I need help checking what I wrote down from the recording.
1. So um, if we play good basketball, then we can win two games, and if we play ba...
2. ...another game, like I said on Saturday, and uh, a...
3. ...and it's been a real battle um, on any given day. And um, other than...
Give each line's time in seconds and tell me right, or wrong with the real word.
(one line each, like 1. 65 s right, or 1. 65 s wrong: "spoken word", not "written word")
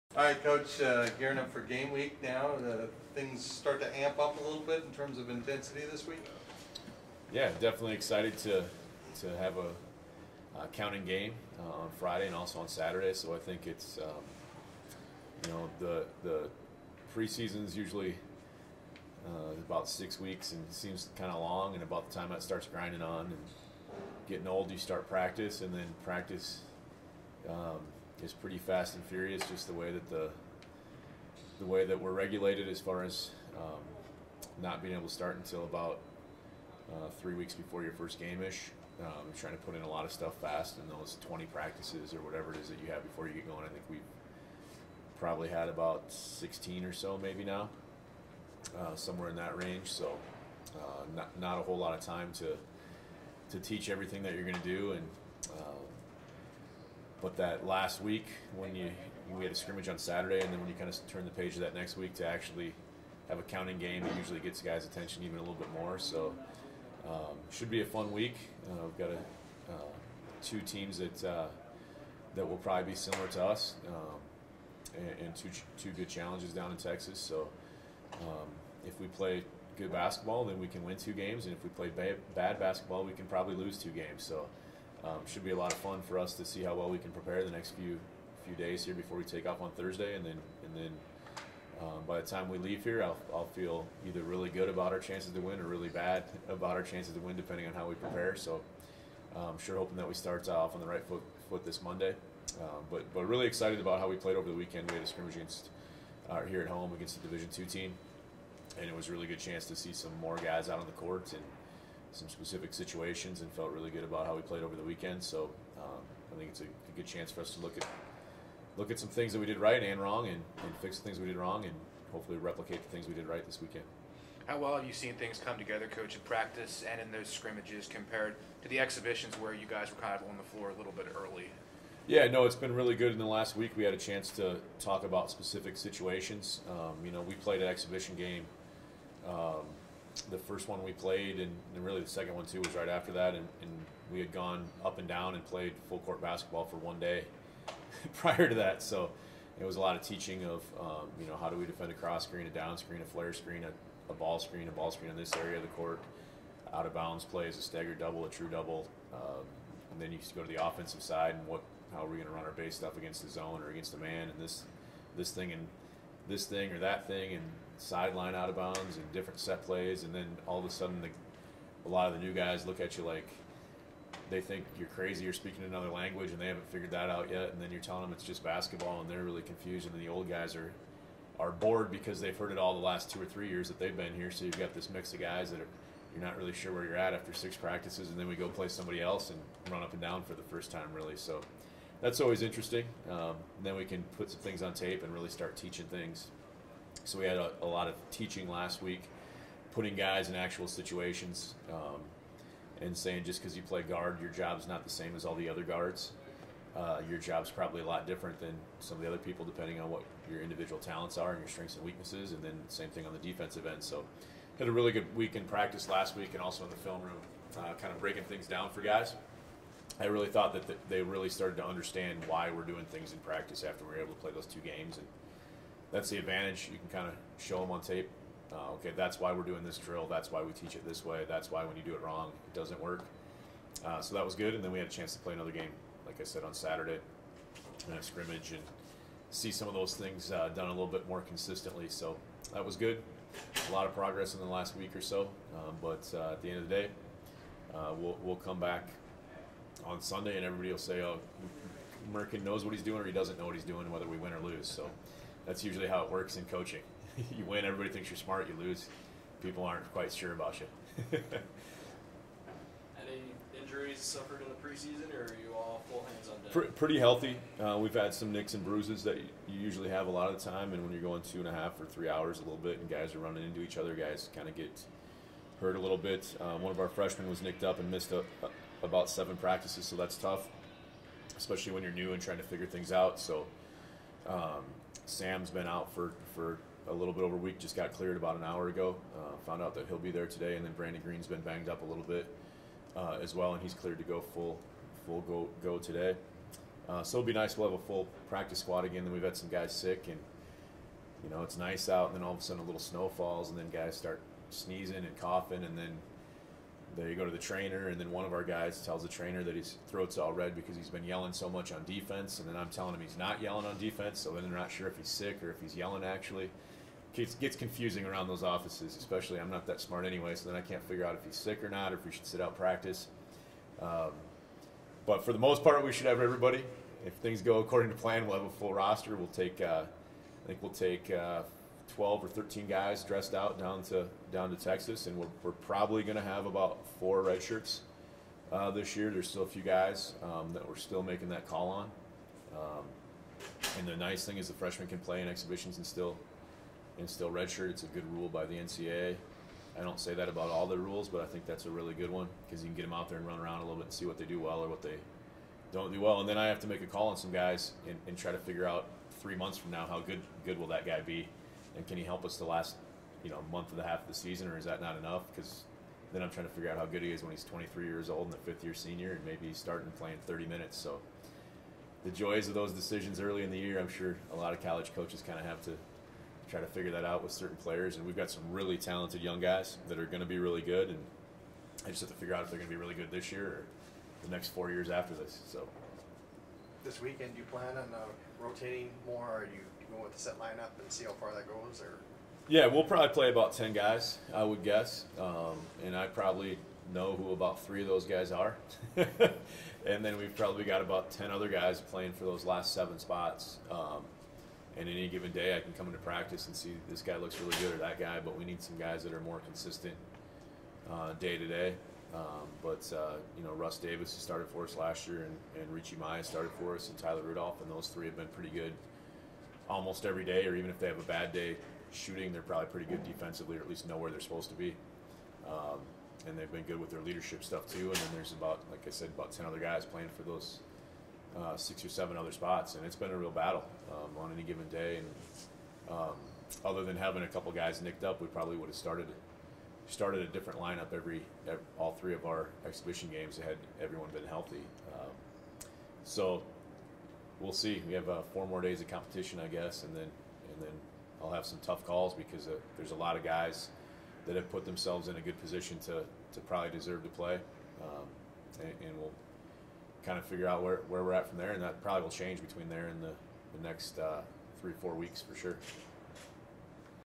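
1. 77 s right
2. 235 s right
3. 432 s right.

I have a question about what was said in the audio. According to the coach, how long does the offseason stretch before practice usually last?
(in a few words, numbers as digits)
About 6 weeks.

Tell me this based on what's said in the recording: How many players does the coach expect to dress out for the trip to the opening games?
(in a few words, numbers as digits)
12 or 13.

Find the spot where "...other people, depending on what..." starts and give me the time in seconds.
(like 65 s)
209 s.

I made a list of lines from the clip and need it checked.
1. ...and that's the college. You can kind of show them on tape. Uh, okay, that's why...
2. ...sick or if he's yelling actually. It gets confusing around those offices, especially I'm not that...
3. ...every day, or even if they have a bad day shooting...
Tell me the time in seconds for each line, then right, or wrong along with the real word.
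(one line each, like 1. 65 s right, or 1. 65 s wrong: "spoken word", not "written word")
1. 224 s wrong: "advantage", not "college"
2. 315 s right
3. 420 s right.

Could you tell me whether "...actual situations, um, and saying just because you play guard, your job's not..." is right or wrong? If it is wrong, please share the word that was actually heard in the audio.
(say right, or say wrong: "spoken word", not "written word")
right.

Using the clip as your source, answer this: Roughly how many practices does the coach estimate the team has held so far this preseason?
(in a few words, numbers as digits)
About 16.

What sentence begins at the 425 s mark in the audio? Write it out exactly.
Um, and they've been good with their leadership stuff too.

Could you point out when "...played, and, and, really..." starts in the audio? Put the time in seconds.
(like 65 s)
140 s.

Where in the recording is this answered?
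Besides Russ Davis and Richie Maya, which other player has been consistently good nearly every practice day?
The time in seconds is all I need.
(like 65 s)
416 s.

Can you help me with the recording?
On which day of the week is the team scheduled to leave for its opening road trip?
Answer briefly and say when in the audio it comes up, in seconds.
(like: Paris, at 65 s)
Thursday, at 89 s.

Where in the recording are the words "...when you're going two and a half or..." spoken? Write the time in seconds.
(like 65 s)
270 s.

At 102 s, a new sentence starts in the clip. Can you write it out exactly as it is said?
Um, but but really excited about how we played over the weekend.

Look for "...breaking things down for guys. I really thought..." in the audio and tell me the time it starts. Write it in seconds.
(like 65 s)
217 s.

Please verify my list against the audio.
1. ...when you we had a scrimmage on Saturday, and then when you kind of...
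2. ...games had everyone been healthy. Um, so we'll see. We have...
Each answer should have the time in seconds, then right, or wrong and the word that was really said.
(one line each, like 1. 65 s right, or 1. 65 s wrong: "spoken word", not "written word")
1. 58 s right
2. 443 s right.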